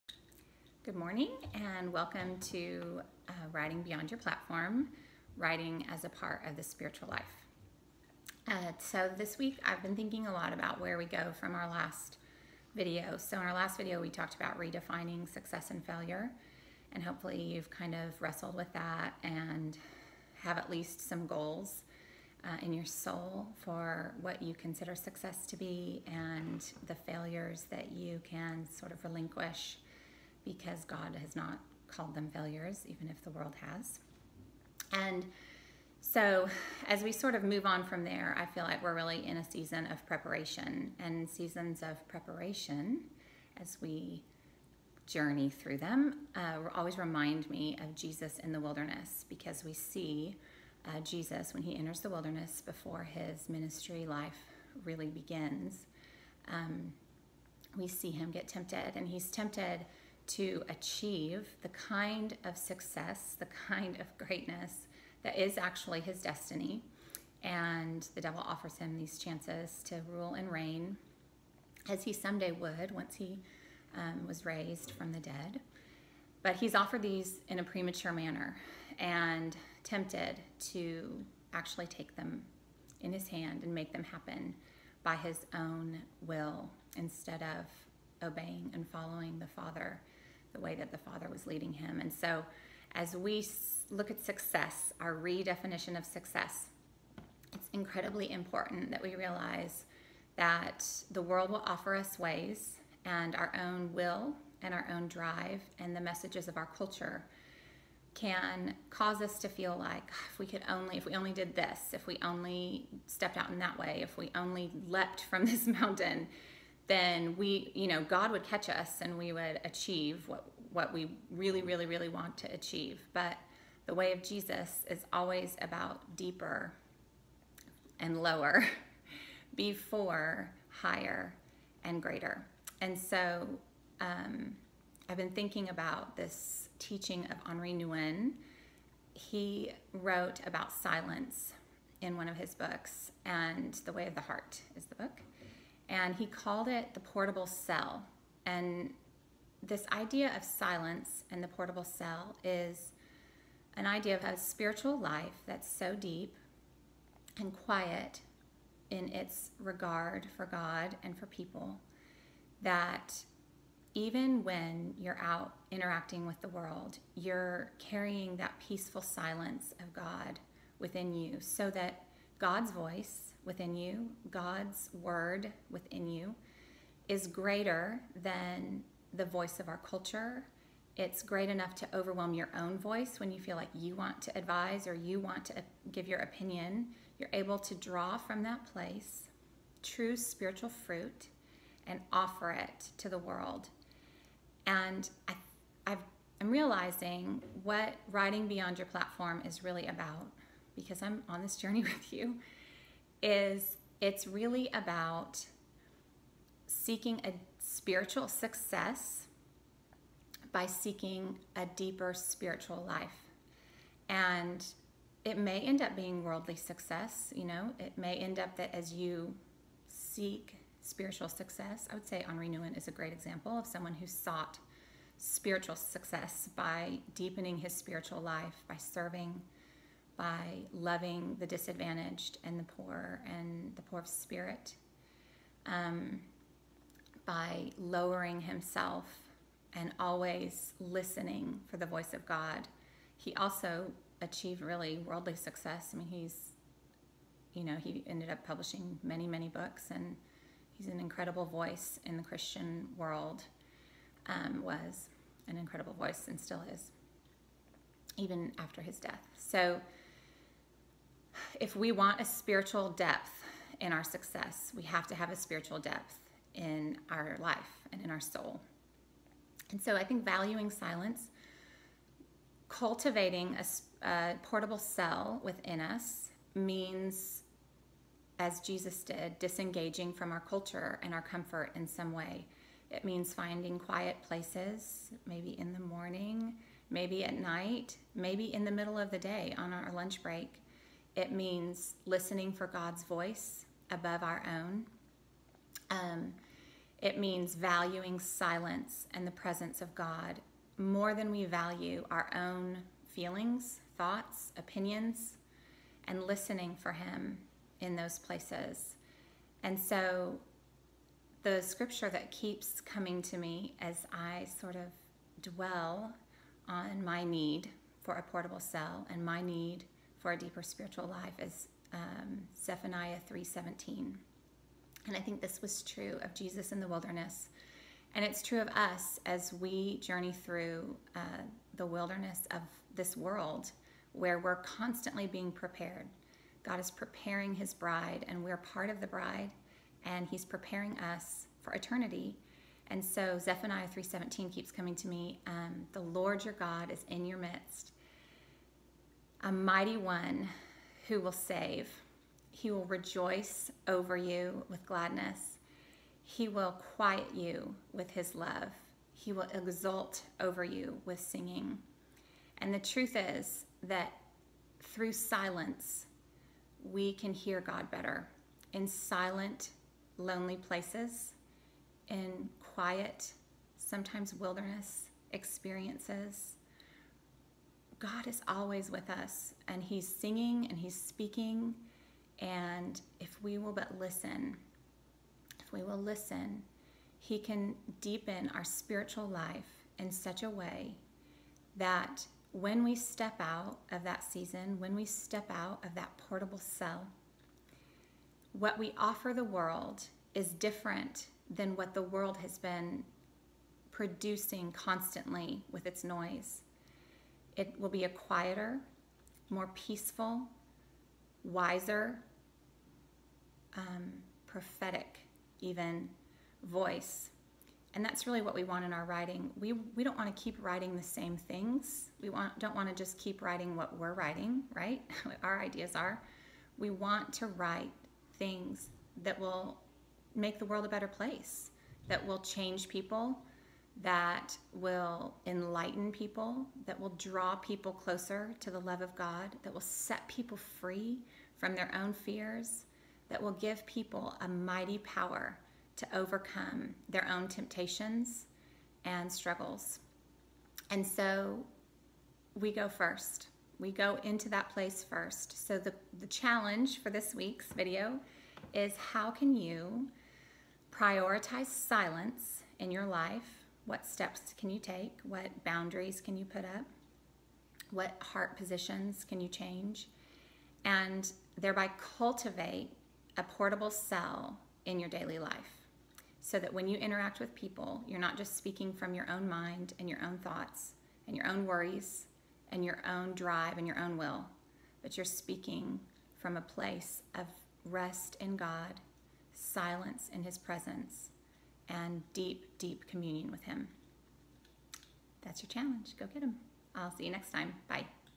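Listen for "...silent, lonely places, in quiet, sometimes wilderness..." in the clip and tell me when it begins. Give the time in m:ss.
6:08.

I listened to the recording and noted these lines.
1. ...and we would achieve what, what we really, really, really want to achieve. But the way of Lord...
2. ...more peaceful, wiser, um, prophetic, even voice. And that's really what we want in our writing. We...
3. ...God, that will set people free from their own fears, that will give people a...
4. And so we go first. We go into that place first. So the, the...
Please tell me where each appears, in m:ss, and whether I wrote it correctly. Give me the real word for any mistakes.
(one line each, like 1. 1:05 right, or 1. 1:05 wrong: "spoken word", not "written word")
1. 1:58 wrong: "Jesus", not "Lord"
2. 6:49 right
3. 7:19 right
4. 7:30 right.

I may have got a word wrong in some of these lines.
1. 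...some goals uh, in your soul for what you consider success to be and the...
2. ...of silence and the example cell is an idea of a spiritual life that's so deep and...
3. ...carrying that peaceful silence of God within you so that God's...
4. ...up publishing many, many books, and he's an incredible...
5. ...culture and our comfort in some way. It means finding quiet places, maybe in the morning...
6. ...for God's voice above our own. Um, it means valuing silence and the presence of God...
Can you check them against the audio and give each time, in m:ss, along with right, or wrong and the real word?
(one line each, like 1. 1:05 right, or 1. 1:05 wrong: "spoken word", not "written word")
1. 0:21 right
2. 2:30 wrong: "portable", not "example"
3. 2:47 right
4. 4:08 right
5. 4:40 right
6. 4:52 right.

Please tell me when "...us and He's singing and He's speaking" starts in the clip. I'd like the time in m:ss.
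6:19.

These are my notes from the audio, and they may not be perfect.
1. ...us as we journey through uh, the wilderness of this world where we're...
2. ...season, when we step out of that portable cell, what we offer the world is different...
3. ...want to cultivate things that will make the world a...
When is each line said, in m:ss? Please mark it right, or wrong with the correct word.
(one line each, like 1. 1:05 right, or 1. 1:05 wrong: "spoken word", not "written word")
1. 5:28 right
2. 6:34 right
3. 7:06 wrong: "write", not "cultivate".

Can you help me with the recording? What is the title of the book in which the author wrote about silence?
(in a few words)
The Way of the Heart.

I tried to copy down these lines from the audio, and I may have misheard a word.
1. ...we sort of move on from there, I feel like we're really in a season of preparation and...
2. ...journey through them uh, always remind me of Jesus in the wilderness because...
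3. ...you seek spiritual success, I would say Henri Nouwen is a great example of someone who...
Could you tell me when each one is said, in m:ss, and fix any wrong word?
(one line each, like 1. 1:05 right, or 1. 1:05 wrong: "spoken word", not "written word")
1. 0:37 right
2. 0:45 right
3. 3:38 right.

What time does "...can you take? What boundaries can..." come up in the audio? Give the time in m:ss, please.
7:44.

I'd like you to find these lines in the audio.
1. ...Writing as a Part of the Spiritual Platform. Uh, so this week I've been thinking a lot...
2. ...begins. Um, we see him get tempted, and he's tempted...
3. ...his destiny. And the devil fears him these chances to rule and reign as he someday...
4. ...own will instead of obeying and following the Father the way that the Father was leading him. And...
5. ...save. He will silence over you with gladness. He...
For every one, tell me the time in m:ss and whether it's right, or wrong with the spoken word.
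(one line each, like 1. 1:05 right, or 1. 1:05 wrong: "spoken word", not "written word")
1. 0:05 wrong: "Life", not "Platform"
2. 0:55 right
3. 1:05 wrong: "offers", not "fears"
4. 1:25 right
5. 5:51 wrong: "rejoice", not "silence".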